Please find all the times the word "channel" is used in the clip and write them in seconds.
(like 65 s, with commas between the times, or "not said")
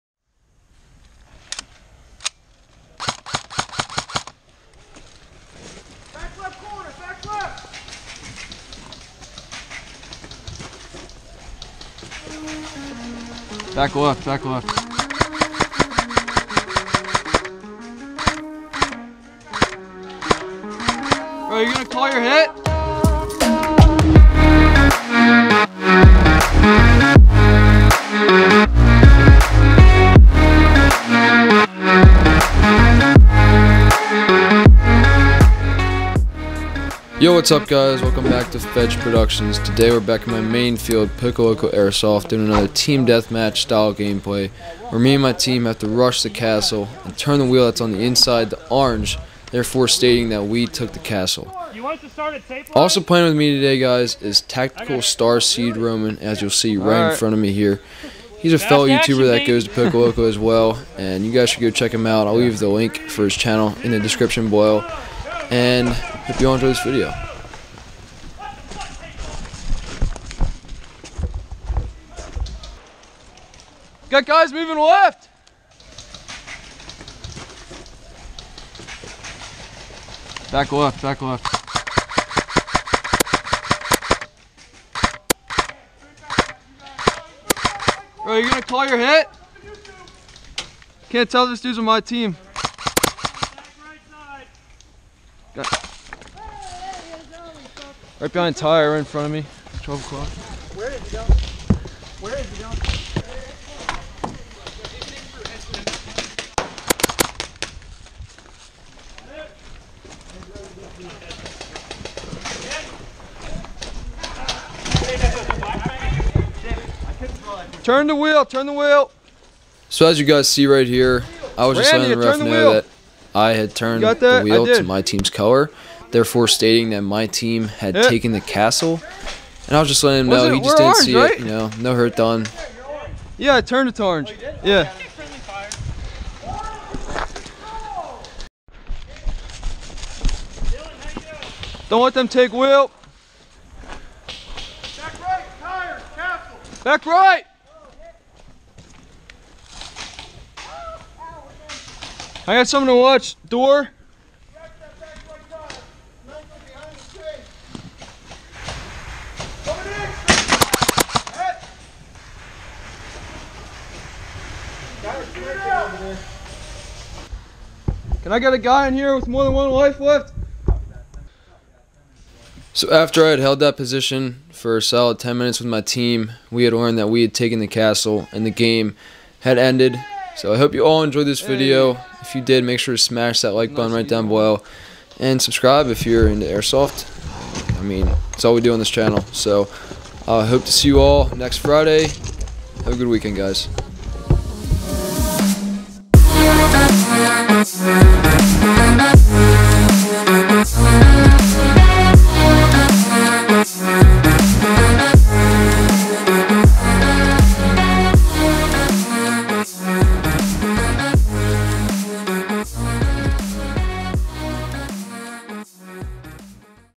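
63 s, 188 s.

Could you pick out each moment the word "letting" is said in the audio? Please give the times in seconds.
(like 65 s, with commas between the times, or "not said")
121 s, 130 s.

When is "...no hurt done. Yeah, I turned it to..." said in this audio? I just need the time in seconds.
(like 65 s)
131 s.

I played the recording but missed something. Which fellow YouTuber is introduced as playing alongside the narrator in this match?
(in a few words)
Tactical Starseed Roman.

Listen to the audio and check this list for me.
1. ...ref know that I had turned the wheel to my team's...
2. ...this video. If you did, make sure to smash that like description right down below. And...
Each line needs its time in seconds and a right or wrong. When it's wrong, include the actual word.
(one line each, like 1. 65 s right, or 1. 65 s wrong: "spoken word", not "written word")
1. 122 s right
2. 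181 s wrong: "button", not "description".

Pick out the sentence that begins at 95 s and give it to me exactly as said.
Got Right behind tire in front of me.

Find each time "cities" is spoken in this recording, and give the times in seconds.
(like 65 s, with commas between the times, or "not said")
not said.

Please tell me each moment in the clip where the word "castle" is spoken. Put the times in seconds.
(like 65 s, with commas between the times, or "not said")
46 s, 50 s, 128 s, 146 s, 177 s.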